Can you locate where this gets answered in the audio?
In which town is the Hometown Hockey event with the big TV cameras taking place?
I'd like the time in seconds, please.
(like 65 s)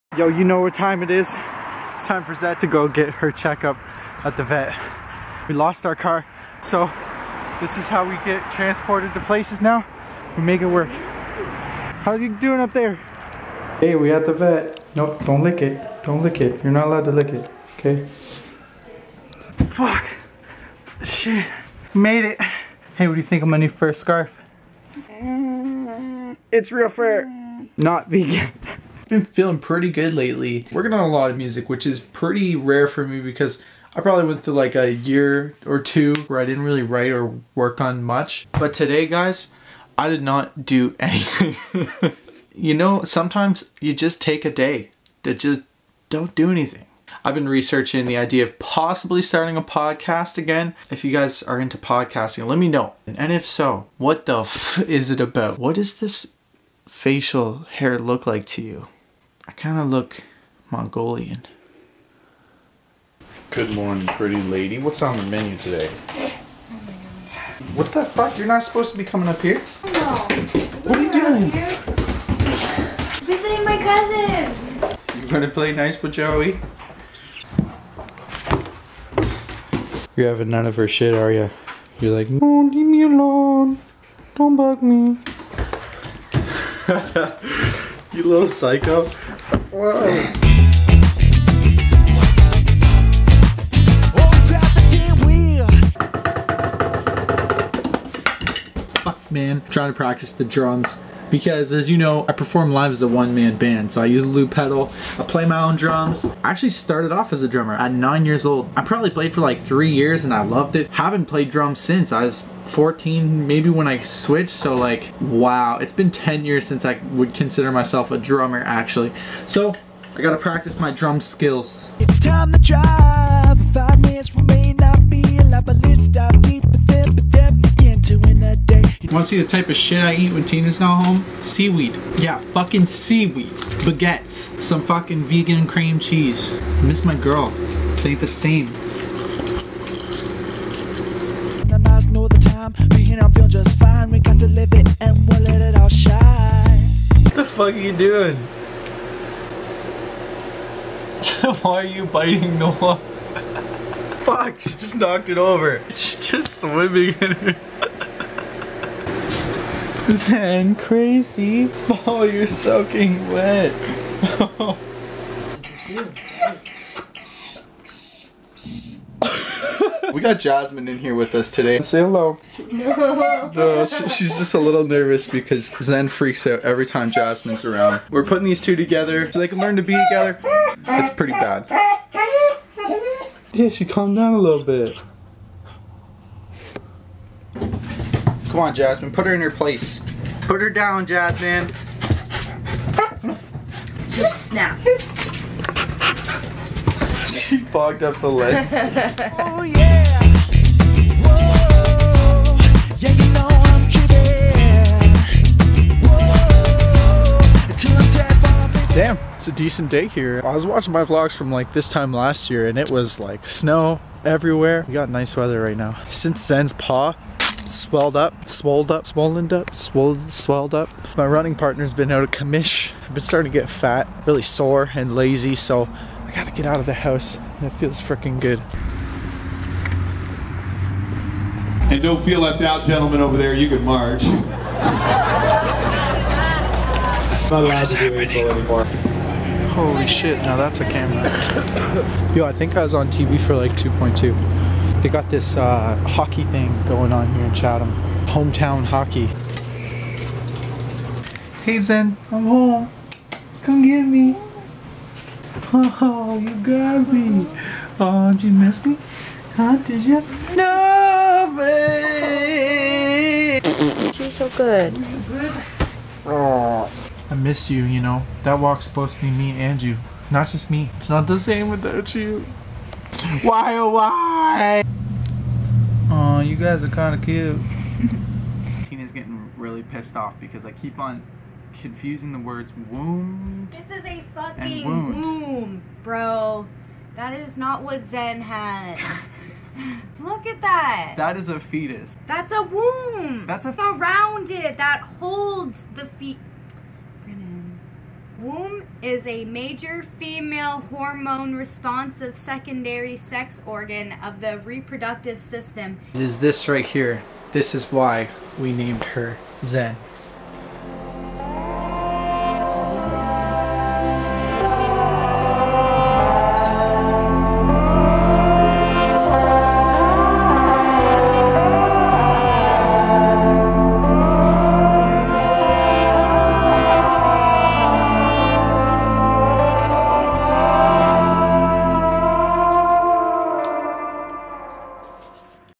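247 s.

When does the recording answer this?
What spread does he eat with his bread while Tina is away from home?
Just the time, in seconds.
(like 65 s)
135 s.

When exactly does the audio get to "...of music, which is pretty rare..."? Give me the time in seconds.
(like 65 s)
31 s.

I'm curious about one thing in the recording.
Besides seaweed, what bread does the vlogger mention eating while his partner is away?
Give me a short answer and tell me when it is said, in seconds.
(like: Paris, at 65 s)
Baguettes, at 133 s.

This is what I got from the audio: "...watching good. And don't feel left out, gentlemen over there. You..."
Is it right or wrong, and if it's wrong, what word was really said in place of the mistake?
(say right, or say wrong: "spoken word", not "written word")
wrong: "freaking", not "watching".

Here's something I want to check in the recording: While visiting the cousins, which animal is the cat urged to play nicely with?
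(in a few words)
Joey.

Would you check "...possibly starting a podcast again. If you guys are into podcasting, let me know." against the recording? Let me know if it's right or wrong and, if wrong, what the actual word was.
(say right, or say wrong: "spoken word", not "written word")
right.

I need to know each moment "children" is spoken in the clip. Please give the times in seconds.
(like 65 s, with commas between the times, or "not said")
not said.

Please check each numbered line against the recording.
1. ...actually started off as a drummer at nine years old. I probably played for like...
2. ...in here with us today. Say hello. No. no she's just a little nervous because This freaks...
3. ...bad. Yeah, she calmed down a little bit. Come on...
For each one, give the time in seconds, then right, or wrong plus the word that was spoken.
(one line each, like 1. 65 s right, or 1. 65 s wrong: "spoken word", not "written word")
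1. 106 s right
2. 170 s wrong: "Zen", not "This"
3. 181 s right.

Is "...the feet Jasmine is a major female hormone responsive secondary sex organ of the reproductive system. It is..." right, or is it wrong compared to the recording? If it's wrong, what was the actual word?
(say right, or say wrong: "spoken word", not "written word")
wrong: "Womb", not "Jasmine".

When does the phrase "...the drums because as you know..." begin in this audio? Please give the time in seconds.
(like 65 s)
100 s.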